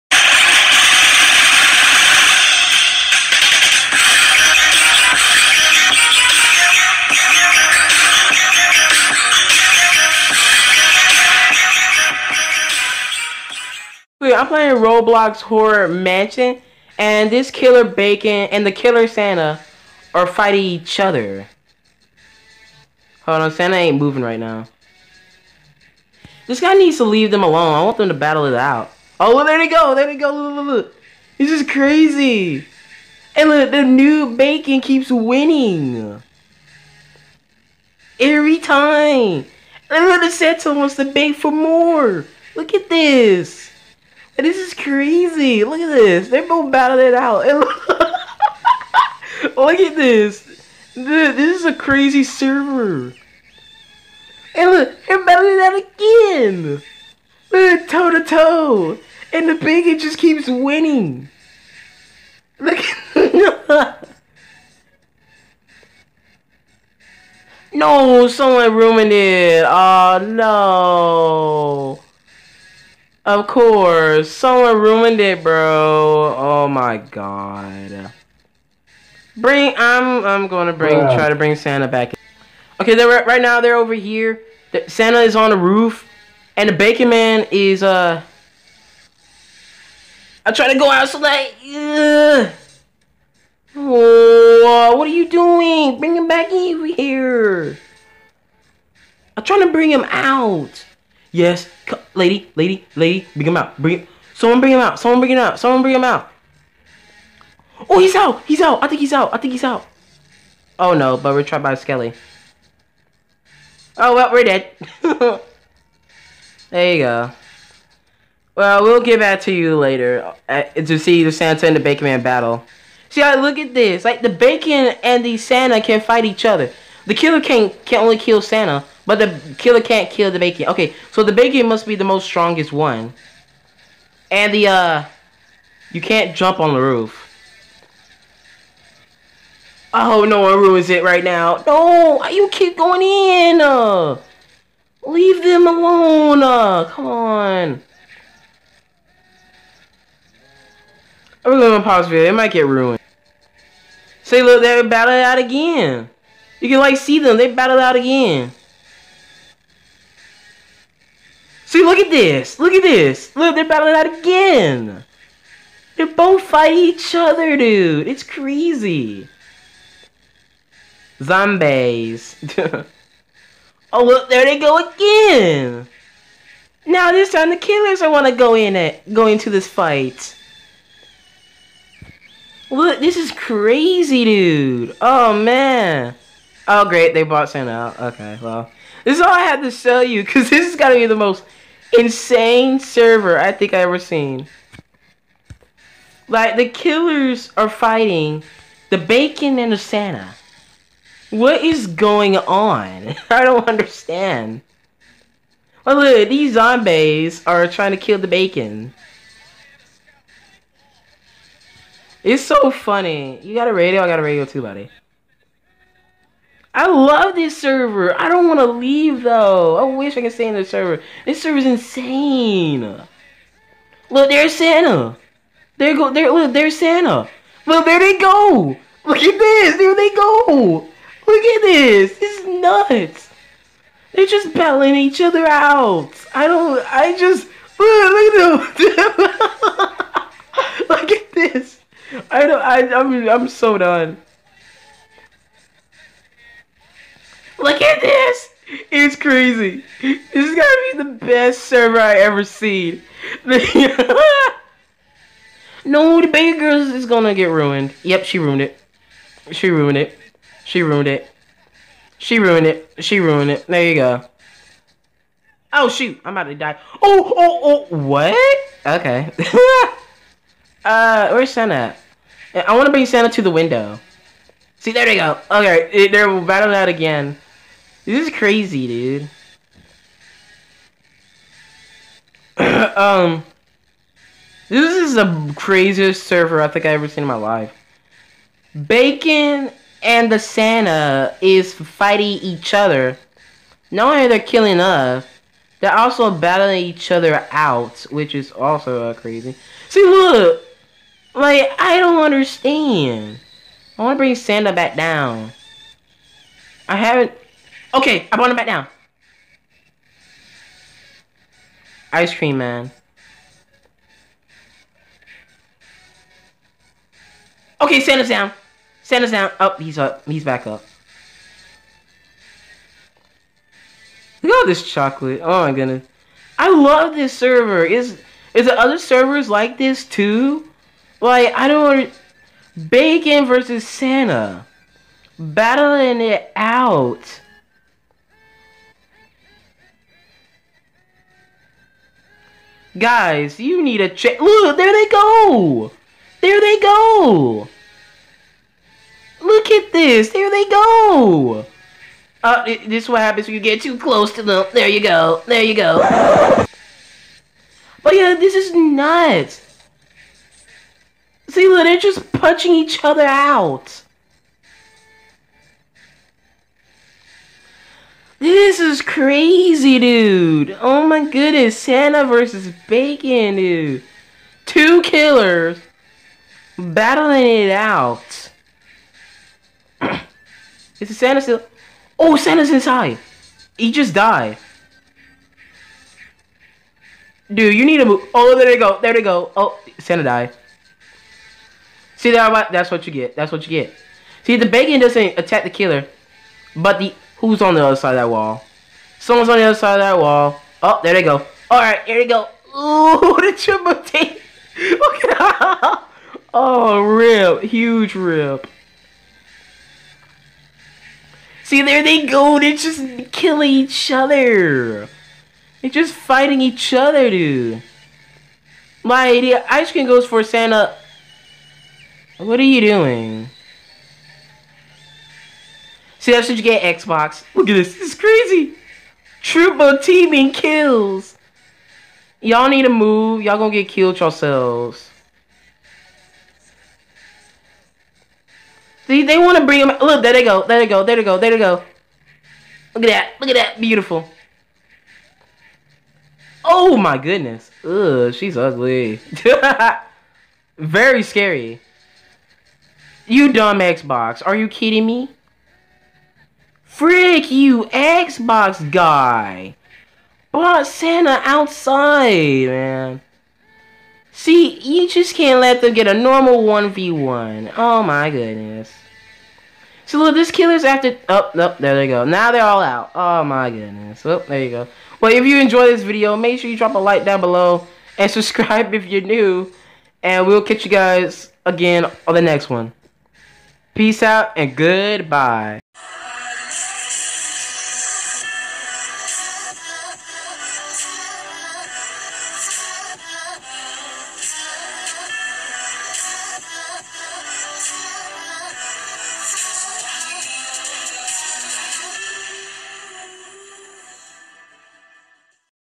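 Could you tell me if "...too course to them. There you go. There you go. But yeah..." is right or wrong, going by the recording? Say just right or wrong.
wrong.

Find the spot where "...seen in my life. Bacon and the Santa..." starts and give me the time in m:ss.
4:47.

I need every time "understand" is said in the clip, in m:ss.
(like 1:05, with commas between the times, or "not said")
3:23, 5:02.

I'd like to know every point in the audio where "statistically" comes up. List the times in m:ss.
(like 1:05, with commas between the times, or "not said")
not said.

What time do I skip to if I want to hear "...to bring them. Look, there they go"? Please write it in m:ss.
7:19.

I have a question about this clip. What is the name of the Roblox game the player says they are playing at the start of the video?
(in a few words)
Horror Mansion.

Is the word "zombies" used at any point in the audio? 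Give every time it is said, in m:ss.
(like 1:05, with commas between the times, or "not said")
2:51, 3:26.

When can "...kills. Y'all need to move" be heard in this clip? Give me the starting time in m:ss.
7:10.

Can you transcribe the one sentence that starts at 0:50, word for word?
Dude, this is a crazy server.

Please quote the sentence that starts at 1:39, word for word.
I'm trying to bring him out.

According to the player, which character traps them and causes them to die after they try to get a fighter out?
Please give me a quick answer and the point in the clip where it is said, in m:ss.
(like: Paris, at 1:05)
Skelly, at 1:51.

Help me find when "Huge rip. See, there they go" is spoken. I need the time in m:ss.
6:47.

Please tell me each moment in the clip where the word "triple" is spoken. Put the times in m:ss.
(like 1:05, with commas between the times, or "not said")
6:43, 7:09.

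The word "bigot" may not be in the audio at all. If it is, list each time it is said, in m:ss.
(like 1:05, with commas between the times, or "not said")
0:59.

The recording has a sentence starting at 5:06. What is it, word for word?
I haven't Okay, I brought him back down.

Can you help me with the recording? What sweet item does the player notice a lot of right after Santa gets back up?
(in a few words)
Chocolate.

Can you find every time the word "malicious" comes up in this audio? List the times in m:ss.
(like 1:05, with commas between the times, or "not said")
not said.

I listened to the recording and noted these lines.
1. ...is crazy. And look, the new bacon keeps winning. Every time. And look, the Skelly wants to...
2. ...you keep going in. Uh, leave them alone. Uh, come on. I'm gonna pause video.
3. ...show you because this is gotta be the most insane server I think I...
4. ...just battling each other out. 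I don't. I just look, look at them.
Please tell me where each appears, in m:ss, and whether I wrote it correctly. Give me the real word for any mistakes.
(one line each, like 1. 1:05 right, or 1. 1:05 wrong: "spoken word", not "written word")
1. 0:31 wrong: "Santa", not "Skelly"
2. 2:22 right
3. 3:09 right
4. 3:54 right.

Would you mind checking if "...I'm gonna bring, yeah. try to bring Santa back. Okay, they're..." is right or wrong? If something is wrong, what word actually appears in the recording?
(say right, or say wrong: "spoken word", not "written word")
right.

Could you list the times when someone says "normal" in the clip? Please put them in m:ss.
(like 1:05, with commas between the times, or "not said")
7:46.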